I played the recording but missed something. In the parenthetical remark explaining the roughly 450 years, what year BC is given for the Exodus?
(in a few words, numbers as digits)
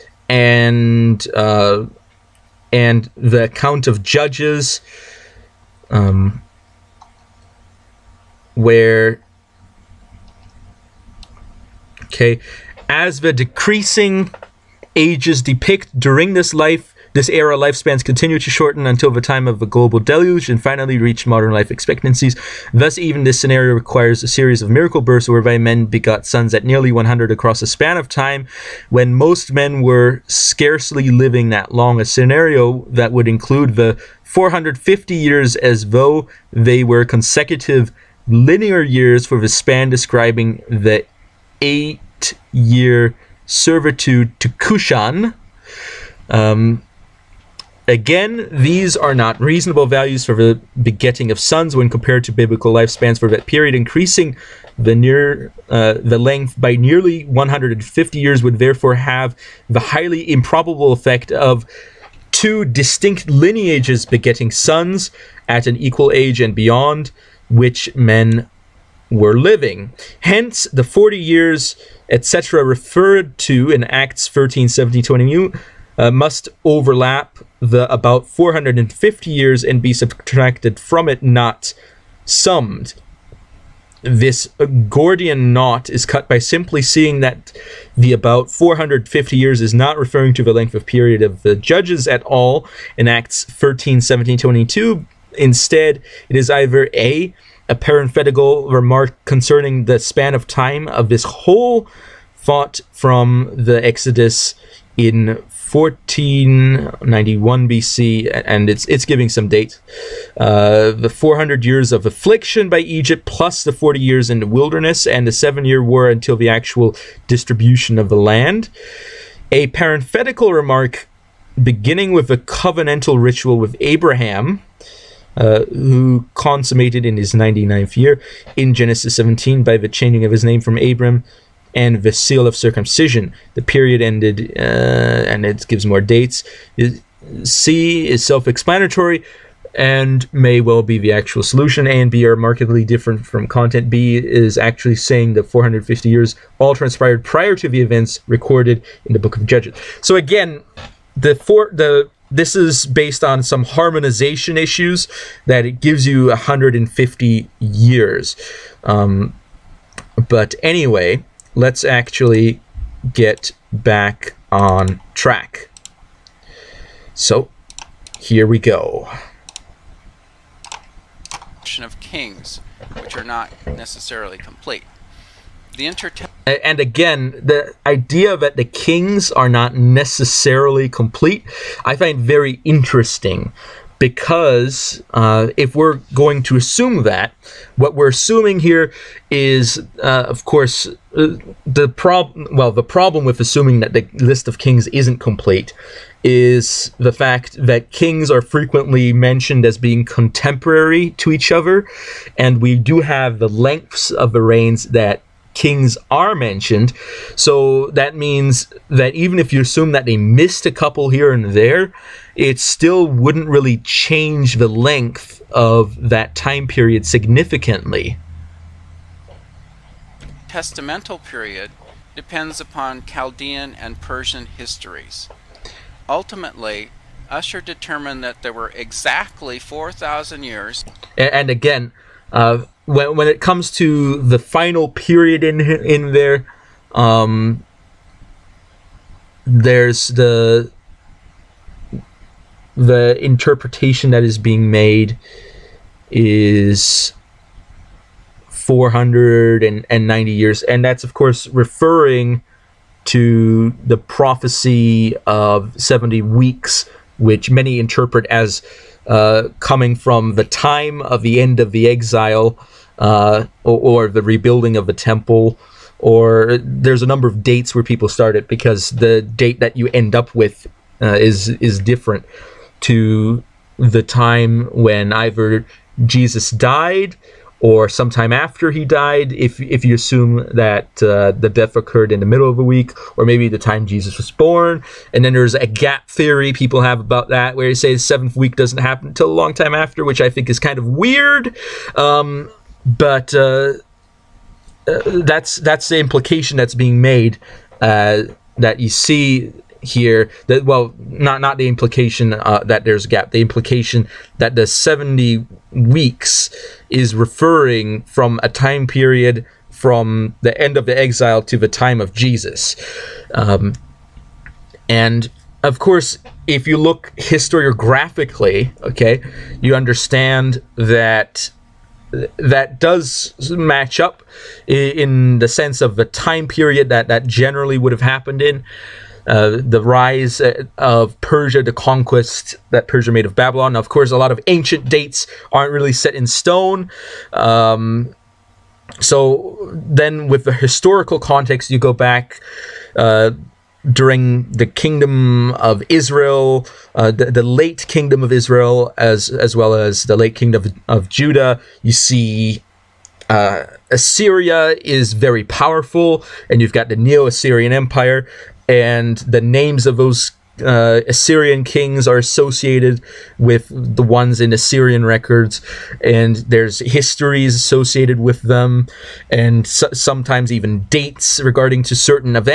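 1491 BC.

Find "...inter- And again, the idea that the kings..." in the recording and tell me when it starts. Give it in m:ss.
2:55.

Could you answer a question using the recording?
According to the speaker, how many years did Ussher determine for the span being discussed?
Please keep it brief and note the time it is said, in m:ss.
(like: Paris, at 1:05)
4,000, at 3:48.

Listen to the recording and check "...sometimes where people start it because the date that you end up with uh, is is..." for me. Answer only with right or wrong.
wrong.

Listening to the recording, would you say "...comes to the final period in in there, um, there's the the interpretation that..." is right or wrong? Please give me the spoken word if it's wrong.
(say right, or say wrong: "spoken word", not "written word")
right.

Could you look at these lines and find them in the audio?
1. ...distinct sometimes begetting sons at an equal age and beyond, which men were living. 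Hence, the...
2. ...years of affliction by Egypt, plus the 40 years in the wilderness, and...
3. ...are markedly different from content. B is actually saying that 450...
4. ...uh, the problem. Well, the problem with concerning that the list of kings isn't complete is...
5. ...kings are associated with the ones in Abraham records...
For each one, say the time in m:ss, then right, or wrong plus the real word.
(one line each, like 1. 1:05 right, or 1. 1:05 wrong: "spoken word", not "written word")
1. 1:02 wrong: "lineages", not "sometimes"
2. 1:51 right
3. 2:22 right
4. 3:11 wrong: "assuming", not "concerning"
5. 6:01 wrong: "Assyrian", not "Abraham".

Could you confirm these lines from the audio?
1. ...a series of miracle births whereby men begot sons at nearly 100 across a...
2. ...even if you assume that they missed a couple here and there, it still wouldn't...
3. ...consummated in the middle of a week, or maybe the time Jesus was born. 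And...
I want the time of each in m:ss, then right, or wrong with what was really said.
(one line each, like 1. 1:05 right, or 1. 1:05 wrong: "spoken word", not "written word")
1. 0:24 right
2. 3:29 right
3. 4:41 wrong: "occurred", not "consummated".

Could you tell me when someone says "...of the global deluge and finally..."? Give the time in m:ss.
0:19.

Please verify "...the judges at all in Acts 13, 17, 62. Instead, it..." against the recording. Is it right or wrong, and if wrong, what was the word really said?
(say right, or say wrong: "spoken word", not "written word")
wrong: "22", not "62".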